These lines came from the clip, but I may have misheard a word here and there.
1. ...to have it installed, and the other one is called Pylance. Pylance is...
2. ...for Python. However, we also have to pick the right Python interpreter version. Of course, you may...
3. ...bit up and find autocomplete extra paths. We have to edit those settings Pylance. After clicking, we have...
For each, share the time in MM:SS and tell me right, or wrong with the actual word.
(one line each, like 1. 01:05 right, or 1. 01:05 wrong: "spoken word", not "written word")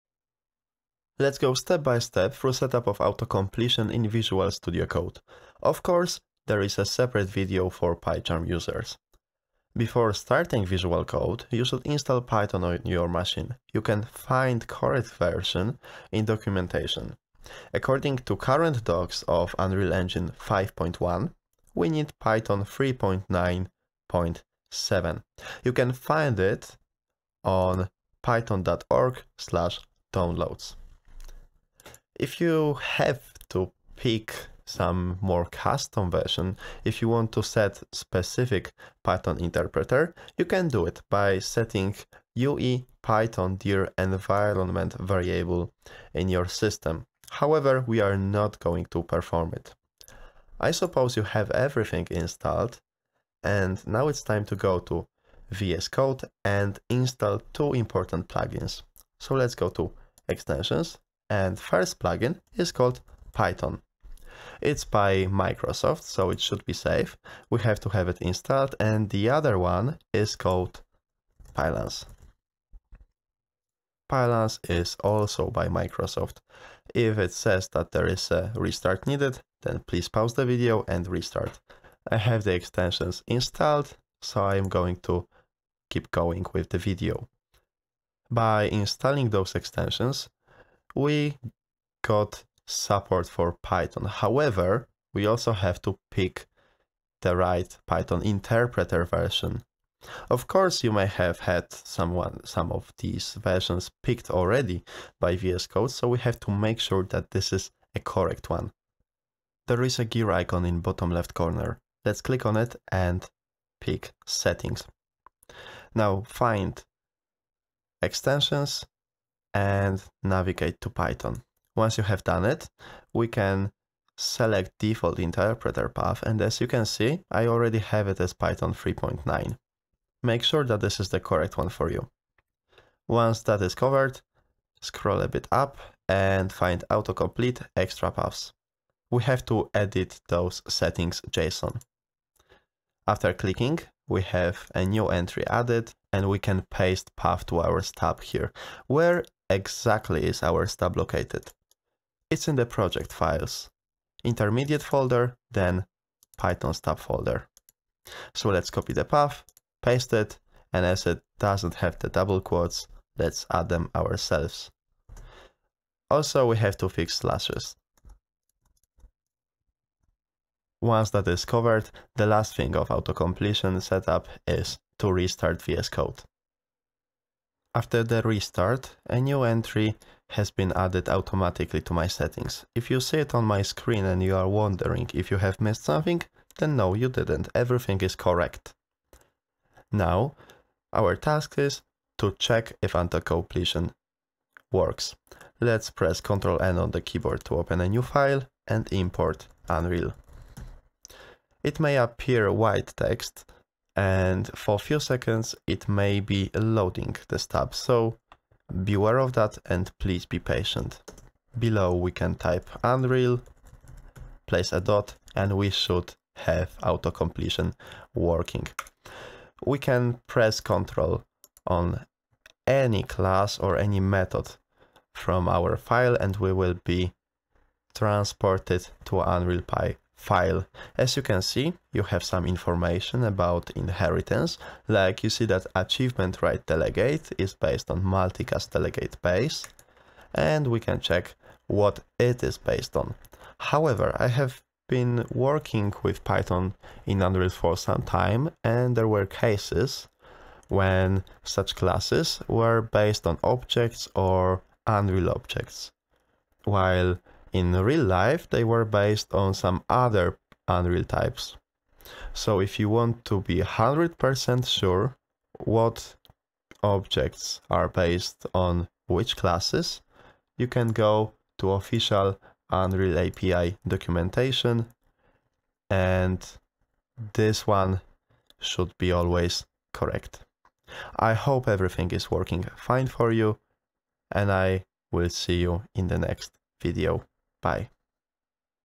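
1. 01:07 right
2. 01:33 right
3. 02:15 wrong: "JSON", not "Pylance".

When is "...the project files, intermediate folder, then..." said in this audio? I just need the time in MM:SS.
02:32.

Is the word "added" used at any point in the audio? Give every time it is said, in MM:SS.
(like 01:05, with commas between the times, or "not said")
02:25, 03:00.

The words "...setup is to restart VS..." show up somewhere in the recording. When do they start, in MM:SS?
02:53.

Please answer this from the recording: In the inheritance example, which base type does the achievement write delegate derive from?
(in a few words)
multicast delegate base.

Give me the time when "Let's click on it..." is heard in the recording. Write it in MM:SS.
01:52.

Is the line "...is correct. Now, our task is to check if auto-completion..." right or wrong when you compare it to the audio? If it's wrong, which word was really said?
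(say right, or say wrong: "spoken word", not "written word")
right.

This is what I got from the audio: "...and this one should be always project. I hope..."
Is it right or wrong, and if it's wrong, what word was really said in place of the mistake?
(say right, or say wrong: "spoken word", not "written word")
wrong: "correct", not "project".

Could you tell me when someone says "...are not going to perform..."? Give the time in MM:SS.
00:48.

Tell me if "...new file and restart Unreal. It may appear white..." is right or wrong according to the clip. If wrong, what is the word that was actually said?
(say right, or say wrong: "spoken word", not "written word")
wrong: "import", not "restart".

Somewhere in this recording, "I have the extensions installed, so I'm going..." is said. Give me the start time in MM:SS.
01:22.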